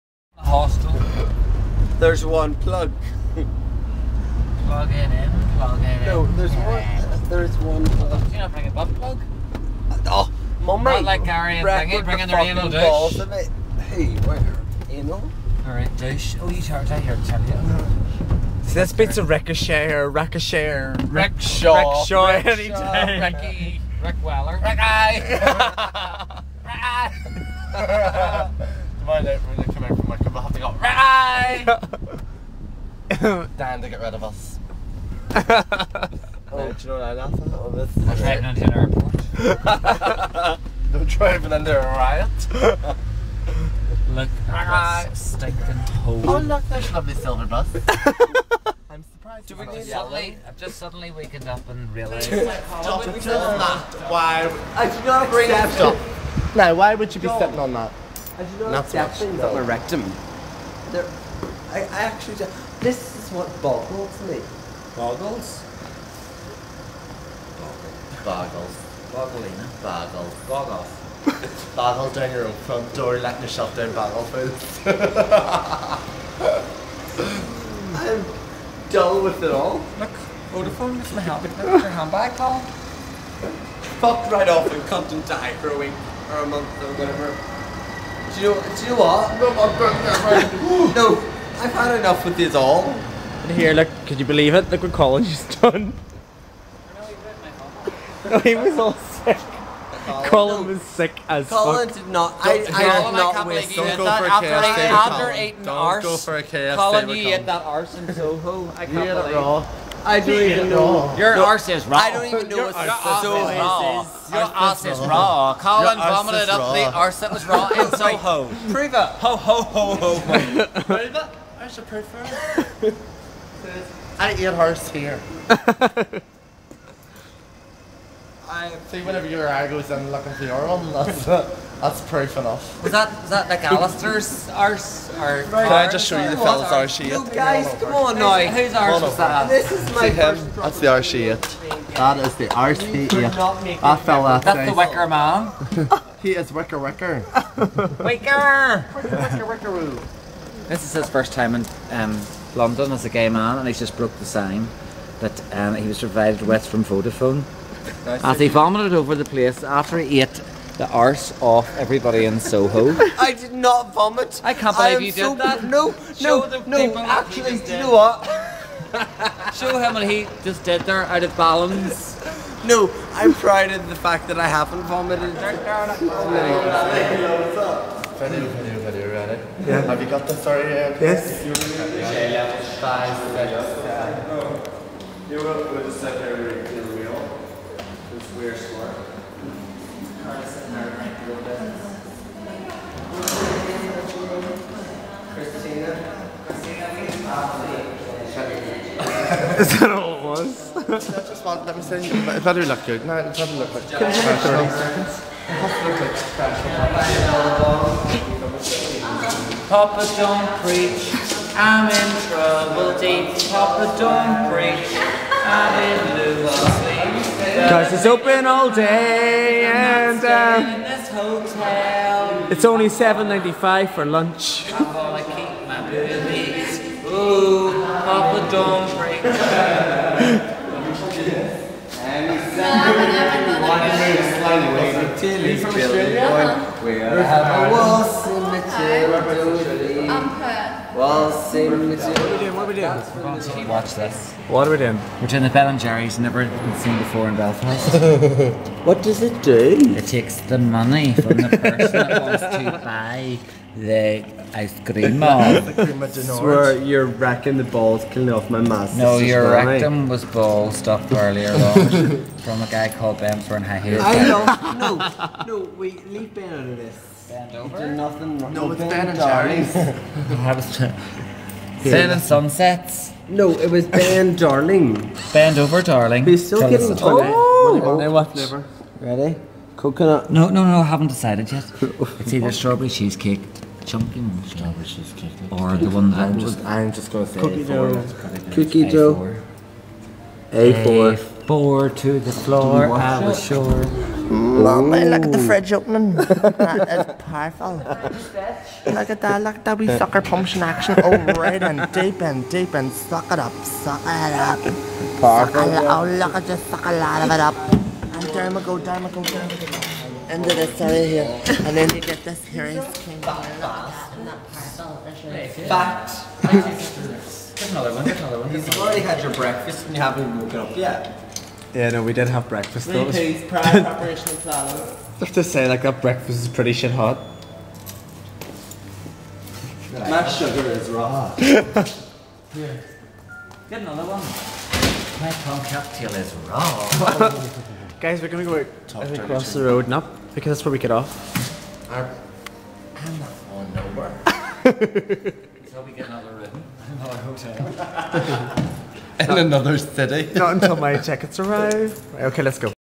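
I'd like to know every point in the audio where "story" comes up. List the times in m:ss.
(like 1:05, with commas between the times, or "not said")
3:00.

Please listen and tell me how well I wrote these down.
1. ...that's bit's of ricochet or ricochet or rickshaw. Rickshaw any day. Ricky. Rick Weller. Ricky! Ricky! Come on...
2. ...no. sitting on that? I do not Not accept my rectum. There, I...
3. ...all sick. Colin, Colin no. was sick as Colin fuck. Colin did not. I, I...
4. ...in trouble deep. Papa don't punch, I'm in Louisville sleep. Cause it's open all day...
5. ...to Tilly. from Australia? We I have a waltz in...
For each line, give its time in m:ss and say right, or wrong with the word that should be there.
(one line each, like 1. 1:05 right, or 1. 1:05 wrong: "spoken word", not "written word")
1. 0:18 right
2. 0:57 right
3. 1:38 right
4. 3:31 wrong: "preach", not "punch"
5. 3:54 right.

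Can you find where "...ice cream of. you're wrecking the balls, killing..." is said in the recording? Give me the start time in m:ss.
4:14.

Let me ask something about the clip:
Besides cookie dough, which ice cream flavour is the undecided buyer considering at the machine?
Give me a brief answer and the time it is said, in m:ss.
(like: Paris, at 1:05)
Strawberry cheesecake, at 4:42.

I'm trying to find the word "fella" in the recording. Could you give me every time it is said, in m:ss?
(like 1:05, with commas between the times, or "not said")
2:16, 2:24.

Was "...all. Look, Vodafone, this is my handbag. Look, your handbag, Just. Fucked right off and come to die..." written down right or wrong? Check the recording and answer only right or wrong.
wrong.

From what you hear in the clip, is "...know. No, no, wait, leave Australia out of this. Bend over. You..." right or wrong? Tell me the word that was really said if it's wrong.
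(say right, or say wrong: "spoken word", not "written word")
wrong: "Ben", not "Australia".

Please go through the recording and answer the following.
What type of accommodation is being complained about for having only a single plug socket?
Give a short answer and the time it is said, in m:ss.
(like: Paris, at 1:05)
Hostel, at 0:00.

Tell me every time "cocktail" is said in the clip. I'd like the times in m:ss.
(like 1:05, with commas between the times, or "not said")
5:35.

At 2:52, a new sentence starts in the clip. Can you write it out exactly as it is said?
No, I'm proud of the fact that I haven't vomited.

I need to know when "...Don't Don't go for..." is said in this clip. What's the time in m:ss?
1:45.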